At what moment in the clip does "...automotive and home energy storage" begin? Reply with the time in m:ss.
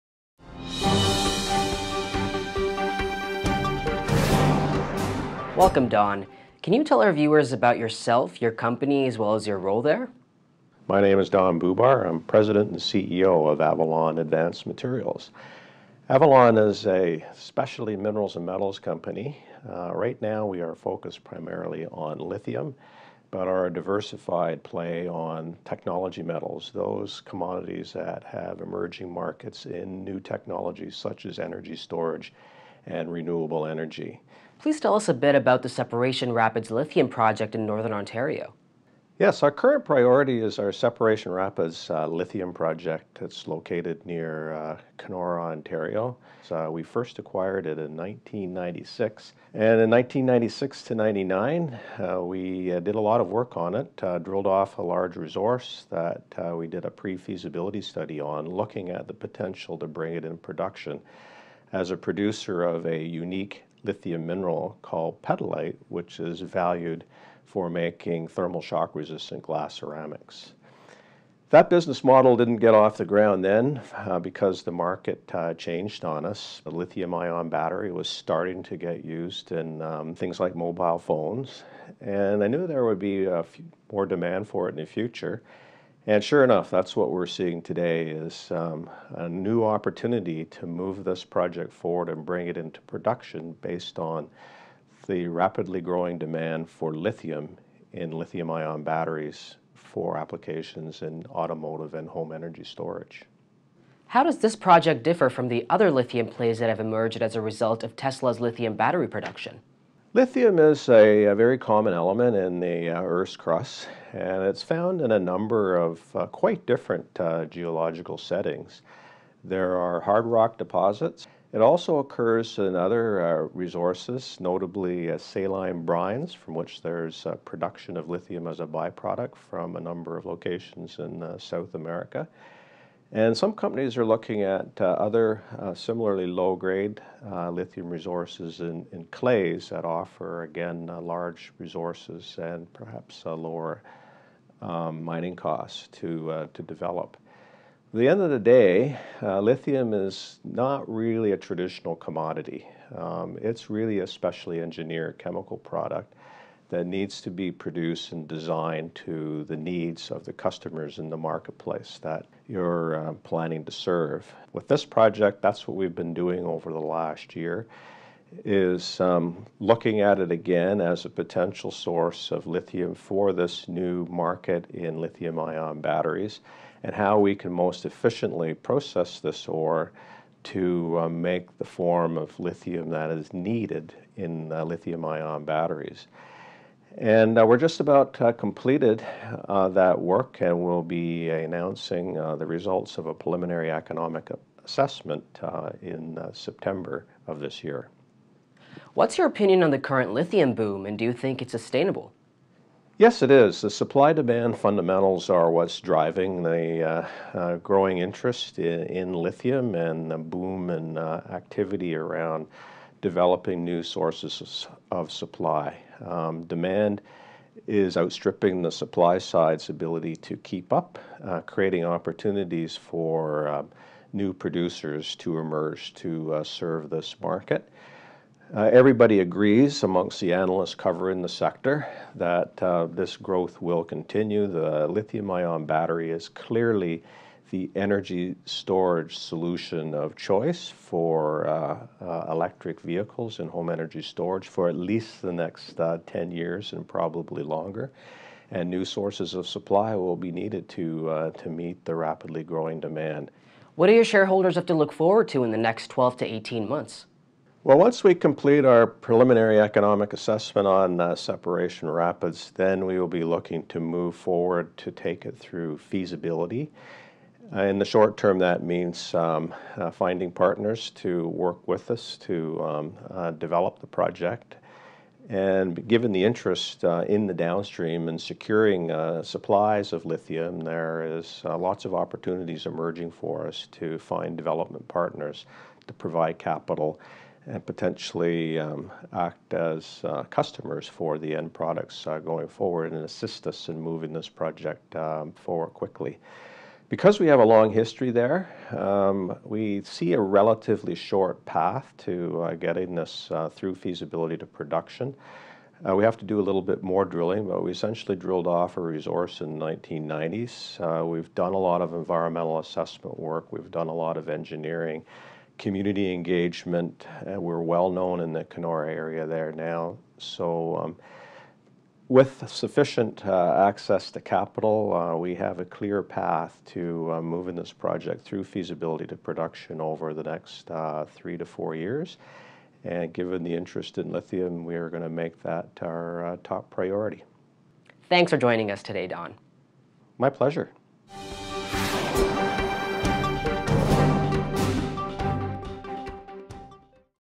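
1:41.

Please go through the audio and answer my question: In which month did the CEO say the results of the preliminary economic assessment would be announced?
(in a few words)
September.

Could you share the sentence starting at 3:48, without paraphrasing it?
Uh, everybody agrees amongst the analysts covering the sector that uh, this growth will continue.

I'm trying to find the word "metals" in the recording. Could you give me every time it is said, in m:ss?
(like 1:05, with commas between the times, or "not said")
0:18, 0:26.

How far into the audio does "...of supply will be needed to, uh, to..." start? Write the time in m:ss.
4:09.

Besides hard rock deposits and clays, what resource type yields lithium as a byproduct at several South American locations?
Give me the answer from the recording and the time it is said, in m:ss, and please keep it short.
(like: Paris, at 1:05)
saline brines, at 2:05.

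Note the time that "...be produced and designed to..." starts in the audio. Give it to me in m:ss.
2:37.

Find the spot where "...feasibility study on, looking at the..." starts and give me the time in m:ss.
0:57.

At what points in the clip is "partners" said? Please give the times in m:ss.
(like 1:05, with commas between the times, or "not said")
4:30, 4:44.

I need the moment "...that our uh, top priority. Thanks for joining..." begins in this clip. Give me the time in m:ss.
5:35.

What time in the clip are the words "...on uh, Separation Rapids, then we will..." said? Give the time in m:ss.
4:20.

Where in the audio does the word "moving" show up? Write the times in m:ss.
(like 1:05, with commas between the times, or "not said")
4:53, 5:27.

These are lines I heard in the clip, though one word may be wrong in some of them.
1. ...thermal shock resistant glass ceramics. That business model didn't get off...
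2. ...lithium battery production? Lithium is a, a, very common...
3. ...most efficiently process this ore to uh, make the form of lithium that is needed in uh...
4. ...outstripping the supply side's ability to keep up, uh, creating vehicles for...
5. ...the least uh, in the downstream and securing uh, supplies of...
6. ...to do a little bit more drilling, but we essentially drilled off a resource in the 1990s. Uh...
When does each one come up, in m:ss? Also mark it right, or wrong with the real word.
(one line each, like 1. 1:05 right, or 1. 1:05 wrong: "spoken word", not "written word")
1. 1:08 right
2. 1:48 right
3. 2:57 right
4. 3:37 wrong: "opportunities", not "vehicles"
5. 4:36 wrong: "interest", not "least"
6. 5:06 right.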